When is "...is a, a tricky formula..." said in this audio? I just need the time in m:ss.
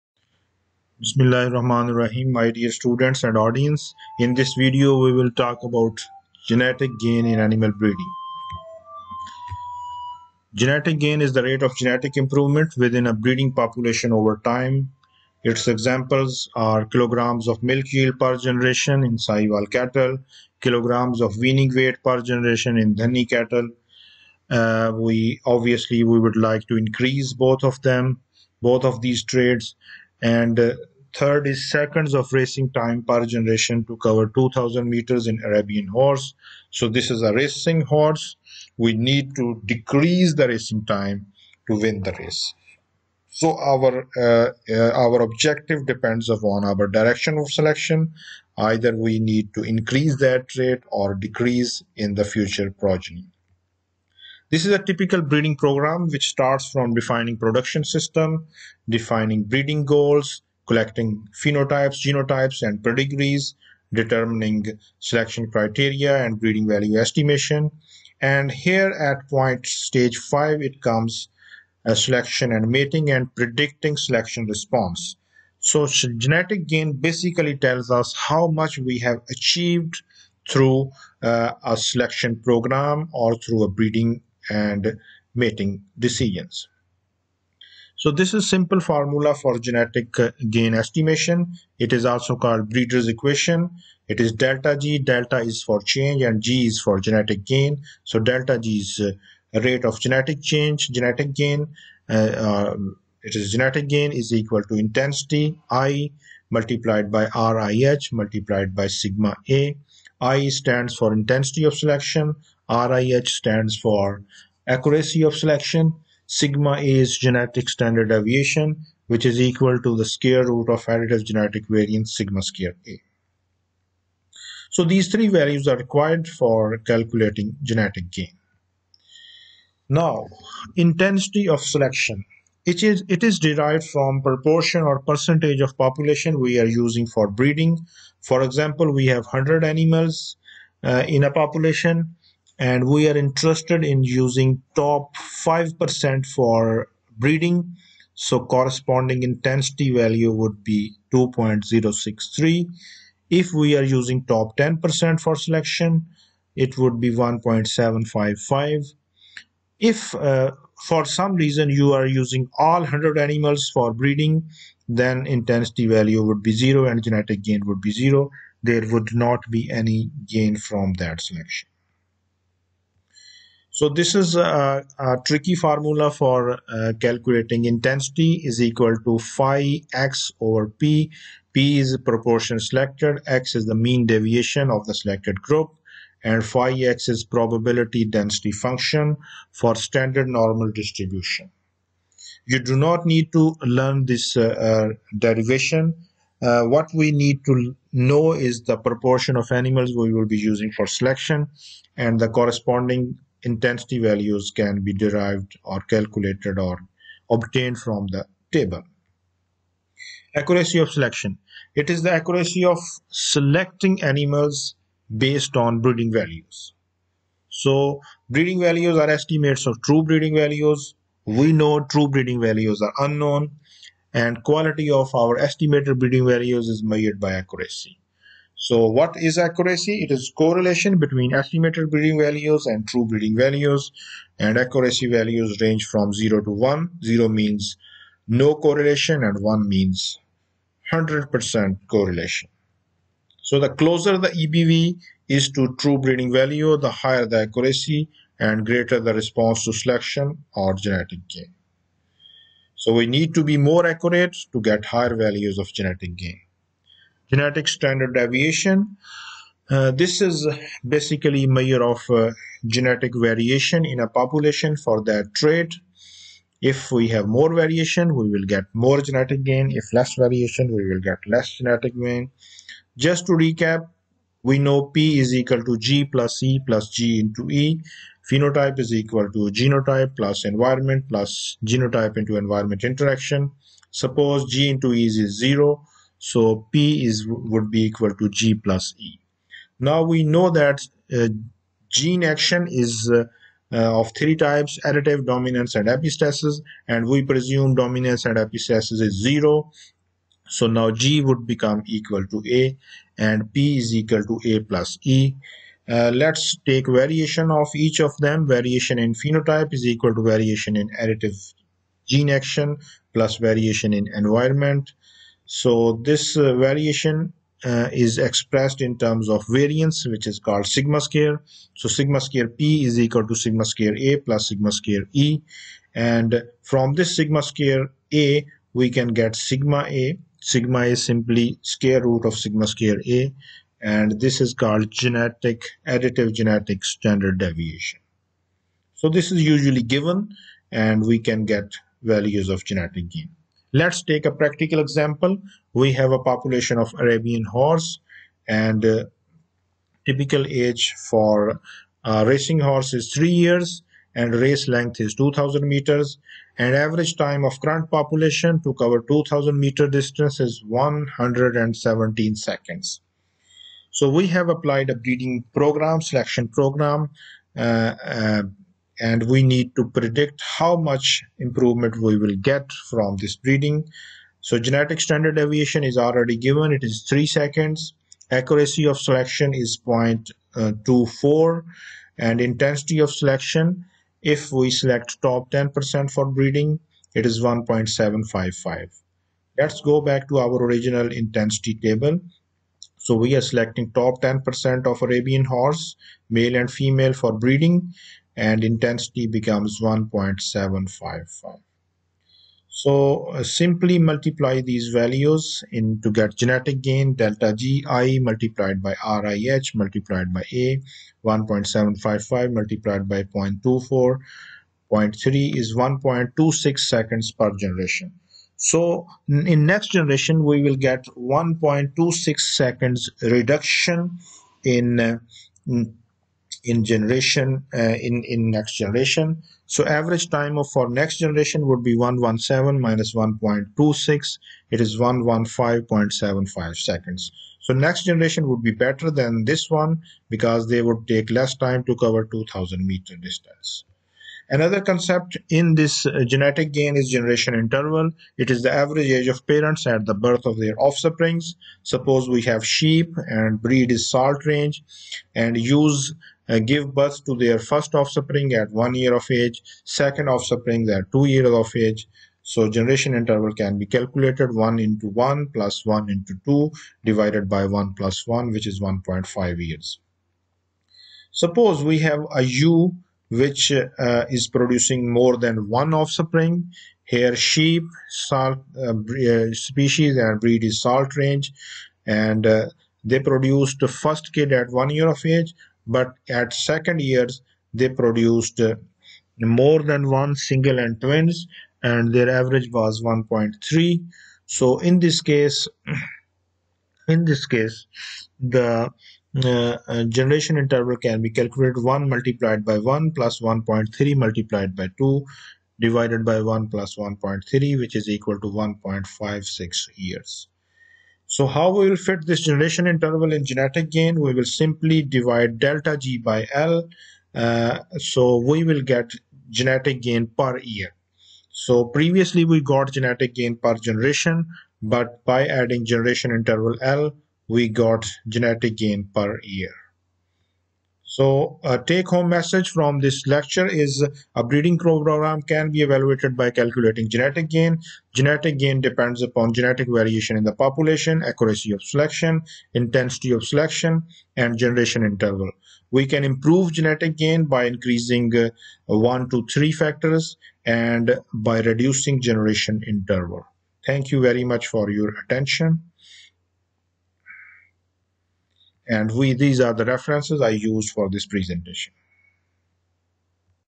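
2:54.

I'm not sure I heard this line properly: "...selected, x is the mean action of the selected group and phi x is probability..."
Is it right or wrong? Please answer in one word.
wrong.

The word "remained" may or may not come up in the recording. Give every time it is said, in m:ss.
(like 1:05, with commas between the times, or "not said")
not said.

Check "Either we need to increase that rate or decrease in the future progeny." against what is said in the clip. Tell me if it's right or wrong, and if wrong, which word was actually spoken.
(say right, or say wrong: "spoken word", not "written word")
right.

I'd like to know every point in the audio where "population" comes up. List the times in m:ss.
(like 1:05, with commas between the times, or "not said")
0:13, 2:15, 2:21, 4:24, 5:46, 5:57, 9:00.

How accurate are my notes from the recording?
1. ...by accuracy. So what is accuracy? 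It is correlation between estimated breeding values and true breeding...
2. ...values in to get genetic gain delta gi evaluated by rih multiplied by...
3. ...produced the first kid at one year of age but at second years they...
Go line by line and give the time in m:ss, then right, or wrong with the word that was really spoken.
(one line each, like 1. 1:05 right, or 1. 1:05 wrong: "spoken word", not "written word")
1. 3:47 right
2. 6:44 wrong: "multiplied", not "evaluated"
3. 8:03 right.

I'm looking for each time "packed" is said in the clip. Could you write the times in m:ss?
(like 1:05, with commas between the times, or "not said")
not said.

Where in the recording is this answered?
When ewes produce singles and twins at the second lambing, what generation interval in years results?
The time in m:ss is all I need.
8:28.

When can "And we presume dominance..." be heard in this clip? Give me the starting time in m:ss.
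4:56.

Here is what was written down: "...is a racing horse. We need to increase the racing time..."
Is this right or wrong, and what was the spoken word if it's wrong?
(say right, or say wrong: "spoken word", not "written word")
wrong: "decrease", not "increase".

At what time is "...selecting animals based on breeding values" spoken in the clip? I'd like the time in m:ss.
3:33.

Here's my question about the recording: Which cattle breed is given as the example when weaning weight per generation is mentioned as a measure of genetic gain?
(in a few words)
Dhanni.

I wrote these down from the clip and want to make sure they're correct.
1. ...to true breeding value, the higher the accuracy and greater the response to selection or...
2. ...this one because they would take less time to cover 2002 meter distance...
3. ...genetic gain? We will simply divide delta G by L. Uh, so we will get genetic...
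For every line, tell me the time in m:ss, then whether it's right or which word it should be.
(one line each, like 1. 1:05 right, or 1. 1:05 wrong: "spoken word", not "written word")
1. 4:05 right
2. 7:19 wrong: "2000", not "2002"
3. 8:33 right.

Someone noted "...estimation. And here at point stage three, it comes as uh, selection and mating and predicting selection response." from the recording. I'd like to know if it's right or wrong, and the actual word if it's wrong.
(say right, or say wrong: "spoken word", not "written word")
wrong: "five", not "three".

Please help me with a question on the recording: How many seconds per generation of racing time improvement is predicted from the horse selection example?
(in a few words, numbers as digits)
1.26.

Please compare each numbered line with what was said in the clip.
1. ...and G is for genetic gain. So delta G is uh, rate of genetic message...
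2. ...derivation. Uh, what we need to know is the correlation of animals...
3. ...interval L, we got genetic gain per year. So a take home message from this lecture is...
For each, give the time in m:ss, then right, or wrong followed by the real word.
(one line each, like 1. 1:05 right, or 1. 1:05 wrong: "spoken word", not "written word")
1. 1:36 wrong: "change", not "message"
2. 3:15 wrong: "proportion", not "correlation"
3. 8:46 right.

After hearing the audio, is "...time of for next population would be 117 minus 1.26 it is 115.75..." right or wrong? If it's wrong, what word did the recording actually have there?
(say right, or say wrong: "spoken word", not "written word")
wrong: "generation", not "population".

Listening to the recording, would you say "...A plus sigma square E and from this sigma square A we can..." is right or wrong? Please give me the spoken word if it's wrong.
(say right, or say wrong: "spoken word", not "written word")
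right.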